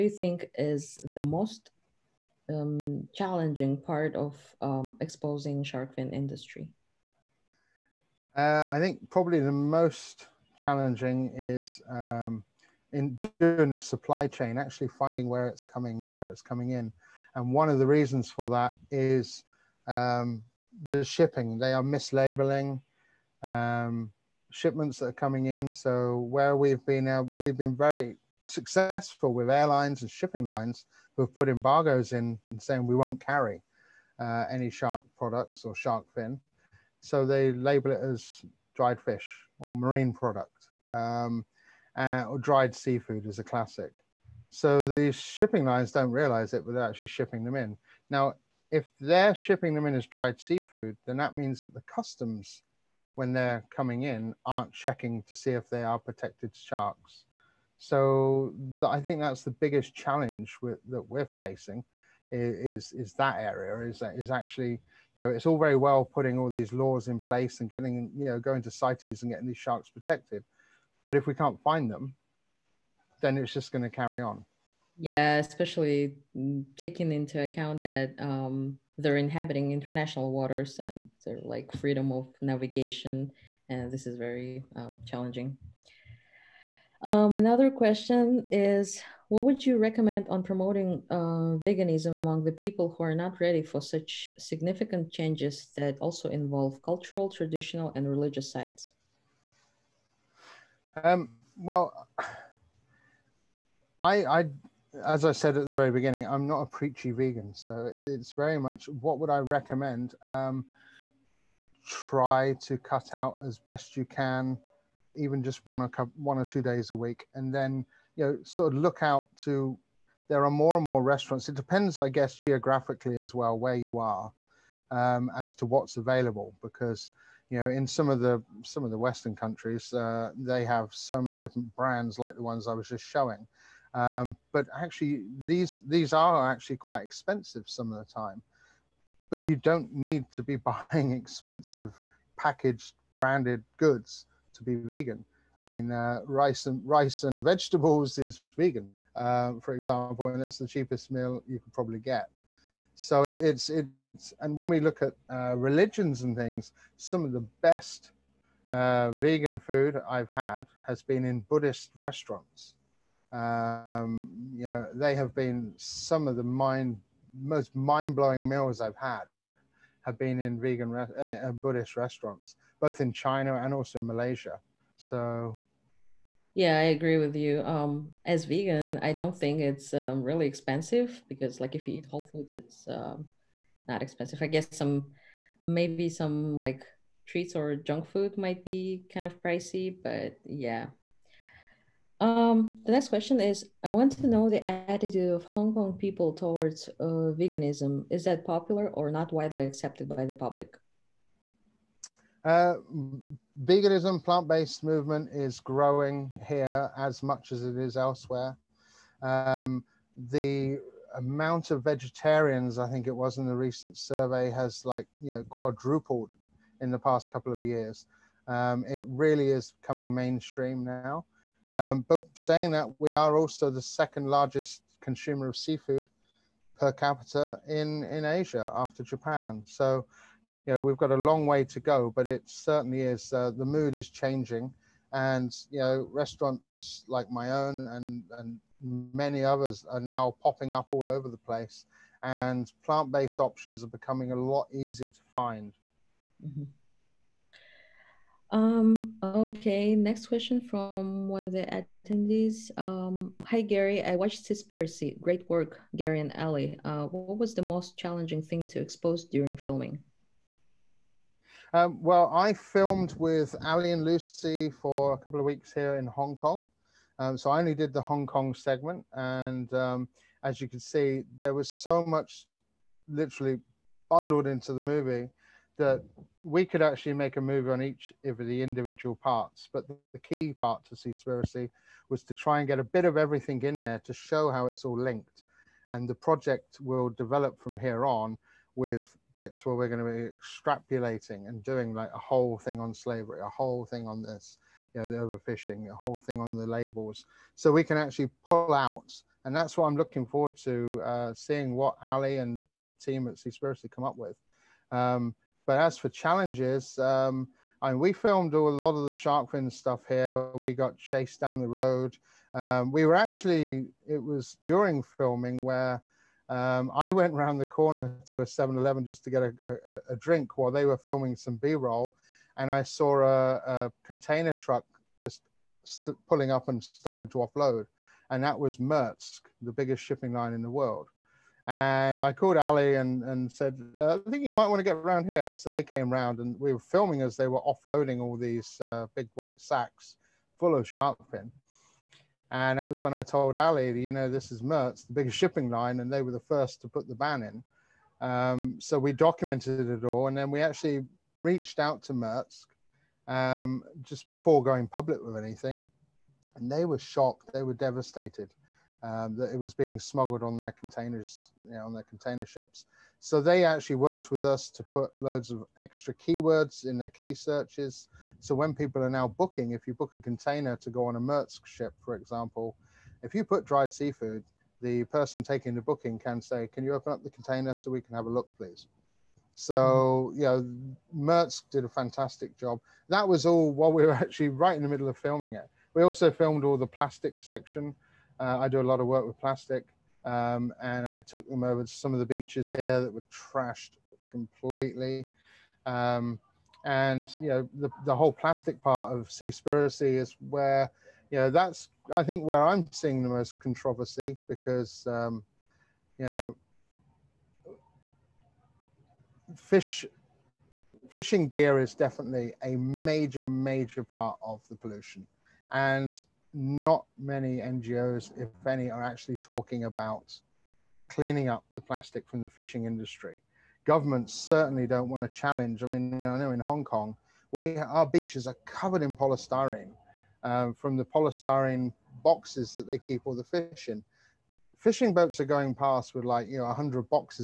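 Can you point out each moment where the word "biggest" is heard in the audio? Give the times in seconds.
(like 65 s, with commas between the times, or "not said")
59 s, 329 s, 345 s.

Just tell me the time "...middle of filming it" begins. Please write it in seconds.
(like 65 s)
384 s.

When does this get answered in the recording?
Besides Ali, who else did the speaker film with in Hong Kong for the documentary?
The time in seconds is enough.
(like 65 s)
264 s.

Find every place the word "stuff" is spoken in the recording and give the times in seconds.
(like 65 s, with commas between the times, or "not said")
309 s.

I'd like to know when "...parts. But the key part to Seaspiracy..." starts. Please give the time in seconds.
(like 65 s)
279 s.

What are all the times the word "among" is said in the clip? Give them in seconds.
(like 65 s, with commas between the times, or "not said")
92 s.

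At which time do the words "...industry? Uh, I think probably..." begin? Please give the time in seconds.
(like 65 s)
6 s.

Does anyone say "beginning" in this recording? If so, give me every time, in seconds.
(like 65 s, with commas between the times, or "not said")
105 s.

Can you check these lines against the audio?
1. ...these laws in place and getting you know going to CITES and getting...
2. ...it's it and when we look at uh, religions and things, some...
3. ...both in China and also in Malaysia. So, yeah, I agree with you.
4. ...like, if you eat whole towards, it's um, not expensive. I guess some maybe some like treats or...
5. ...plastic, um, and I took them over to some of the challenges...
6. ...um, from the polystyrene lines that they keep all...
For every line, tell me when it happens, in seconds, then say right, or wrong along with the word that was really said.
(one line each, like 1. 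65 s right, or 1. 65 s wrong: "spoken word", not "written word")
1. 66 s right
2. 153 s right
3. 172 s right
4. 181 s wrong: "foods", not "towards"
5. 389 s wrong: "beaches", not "challenges"
6. 430 s wrong: "boxes", not "lines".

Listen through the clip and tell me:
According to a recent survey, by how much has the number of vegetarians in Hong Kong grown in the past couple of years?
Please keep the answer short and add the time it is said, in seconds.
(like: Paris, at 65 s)
Quadrupled, at 215 s.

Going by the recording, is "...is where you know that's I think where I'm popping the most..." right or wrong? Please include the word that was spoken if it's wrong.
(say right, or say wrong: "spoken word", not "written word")
wrong: "seeing", not "popping".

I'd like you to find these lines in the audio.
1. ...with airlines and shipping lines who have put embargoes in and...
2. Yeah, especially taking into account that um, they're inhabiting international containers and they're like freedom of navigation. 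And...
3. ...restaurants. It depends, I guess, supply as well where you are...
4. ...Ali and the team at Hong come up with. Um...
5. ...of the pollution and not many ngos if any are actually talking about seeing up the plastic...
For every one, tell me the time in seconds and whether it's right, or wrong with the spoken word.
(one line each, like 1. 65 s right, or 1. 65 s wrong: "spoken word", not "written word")
1. 29 s right
2. 74 s wrong: "waters", not "containers"
3. 121 s wrong: "geographically", not "supply"
4. 302 s wrong: "Seaspiracy", not "Hong"
5. 414 s wrong: "cleaning", not "seeing".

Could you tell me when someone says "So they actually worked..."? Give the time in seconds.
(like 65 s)
363 s.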